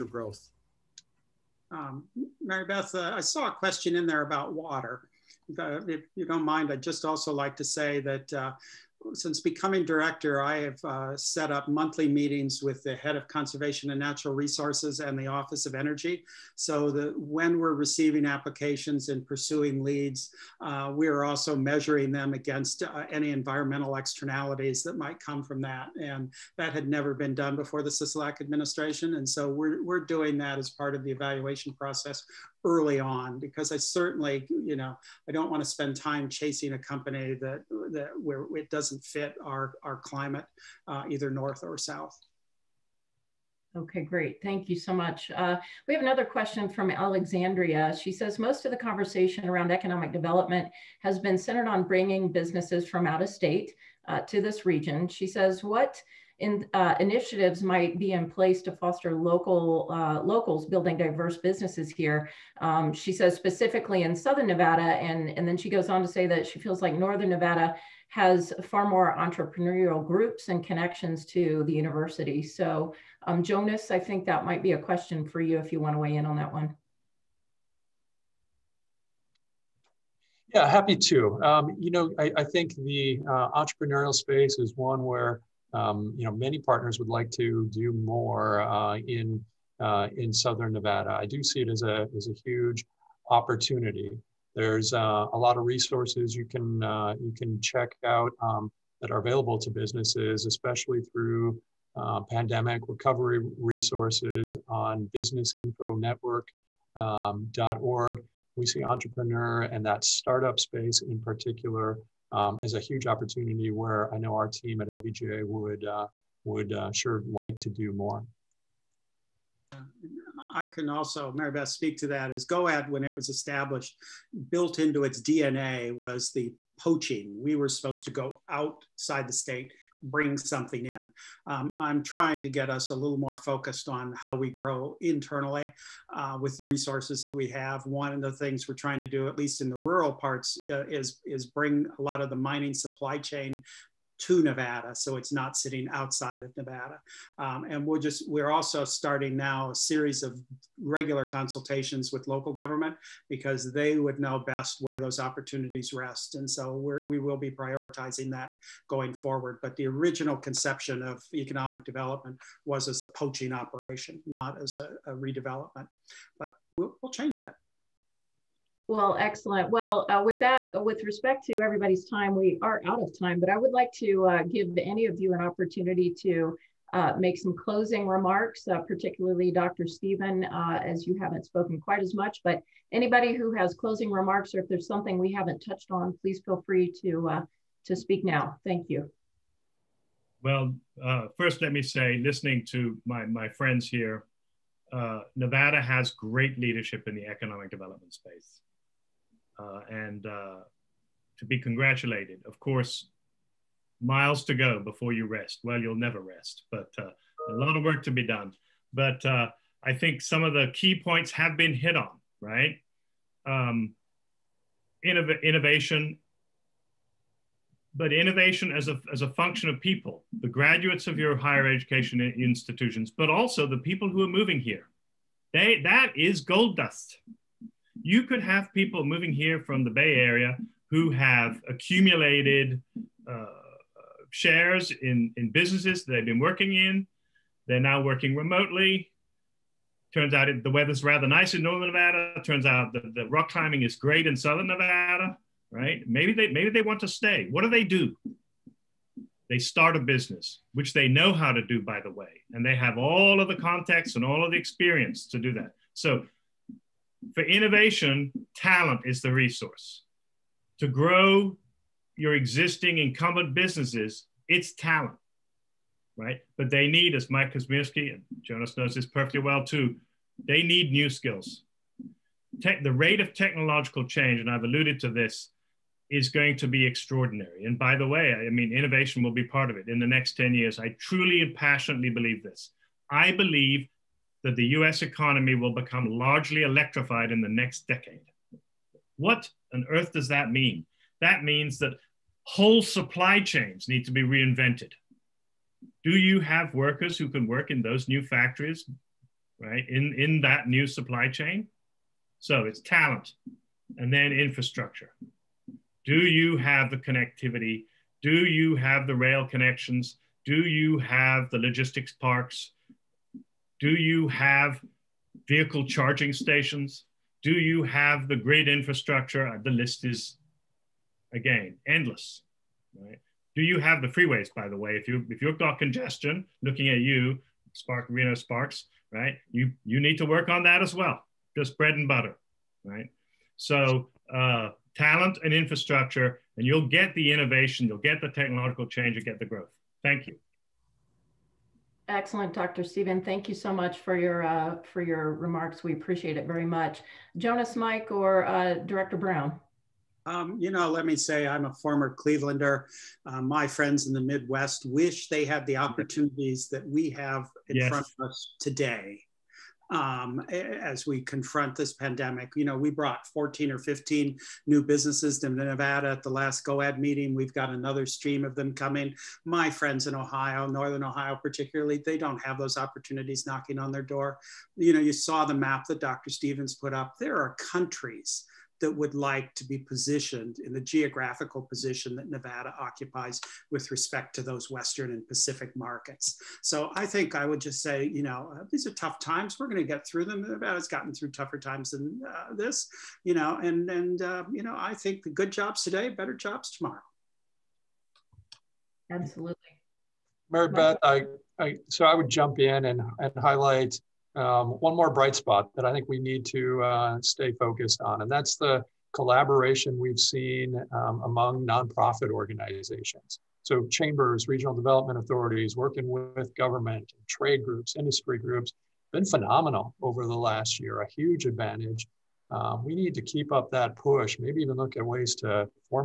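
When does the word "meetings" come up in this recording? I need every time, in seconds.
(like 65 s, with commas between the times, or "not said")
12 s, 366 s.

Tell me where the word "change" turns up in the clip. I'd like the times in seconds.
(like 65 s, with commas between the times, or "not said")
167 s, 274 s, 338 s.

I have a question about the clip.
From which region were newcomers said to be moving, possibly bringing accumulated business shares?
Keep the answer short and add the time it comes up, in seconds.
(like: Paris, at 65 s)
Bay Area, at 229 s.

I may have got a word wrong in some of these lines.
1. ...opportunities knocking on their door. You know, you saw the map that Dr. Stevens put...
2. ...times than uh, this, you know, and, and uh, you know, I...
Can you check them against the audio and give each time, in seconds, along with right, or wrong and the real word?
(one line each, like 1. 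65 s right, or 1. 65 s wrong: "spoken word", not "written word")
1. 372 s right
2. 391 s right.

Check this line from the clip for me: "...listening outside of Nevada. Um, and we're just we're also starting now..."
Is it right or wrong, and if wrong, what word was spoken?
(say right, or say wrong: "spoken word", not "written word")
wrong: "sitting", not "listening".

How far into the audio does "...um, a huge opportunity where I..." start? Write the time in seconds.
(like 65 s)
112 s.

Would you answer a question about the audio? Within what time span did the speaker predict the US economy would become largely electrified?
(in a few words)
next decade.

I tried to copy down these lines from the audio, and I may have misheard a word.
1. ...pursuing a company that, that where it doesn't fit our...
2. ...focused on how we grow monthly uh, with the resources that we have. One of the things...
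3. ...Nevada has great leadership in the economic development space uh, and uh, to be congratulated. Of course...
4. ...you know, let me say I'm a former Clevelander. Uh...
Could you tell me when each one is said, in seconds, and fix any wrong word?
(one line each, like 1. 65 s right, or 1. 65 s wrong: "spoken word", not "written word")
1. 36 s wrong: "chasing", not "pursuing"
2. 133 s wrong: "internally", not "monthly"
3. 195 s right
4. 350 s right.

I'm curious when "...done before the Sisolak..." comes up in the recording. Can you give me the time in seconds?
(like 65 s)
27 s.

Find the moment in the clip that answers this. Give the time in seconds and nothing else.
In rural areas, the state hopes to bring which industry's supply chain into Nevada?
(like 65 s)
142 s.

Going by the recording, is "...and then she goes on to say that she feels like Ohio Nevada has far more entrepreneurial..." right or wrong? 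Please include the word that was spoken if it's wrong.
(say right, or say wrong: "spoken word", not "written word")
wrong: "Northern", not "Ohio".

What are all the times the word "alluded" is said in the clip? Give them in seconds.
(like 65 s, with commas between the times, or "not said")
274 s.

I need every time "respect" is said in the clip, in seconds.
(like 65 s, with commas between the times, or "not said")
171 s, 383 s.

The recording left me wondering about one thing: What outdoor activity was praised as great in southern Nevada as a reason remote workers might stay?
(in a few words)
rock climbing.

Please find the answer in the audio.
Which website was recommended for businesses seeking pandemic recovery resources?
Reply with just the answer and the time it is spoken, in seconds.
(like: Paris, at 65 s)
businessinfonetwork.org, at 105 s.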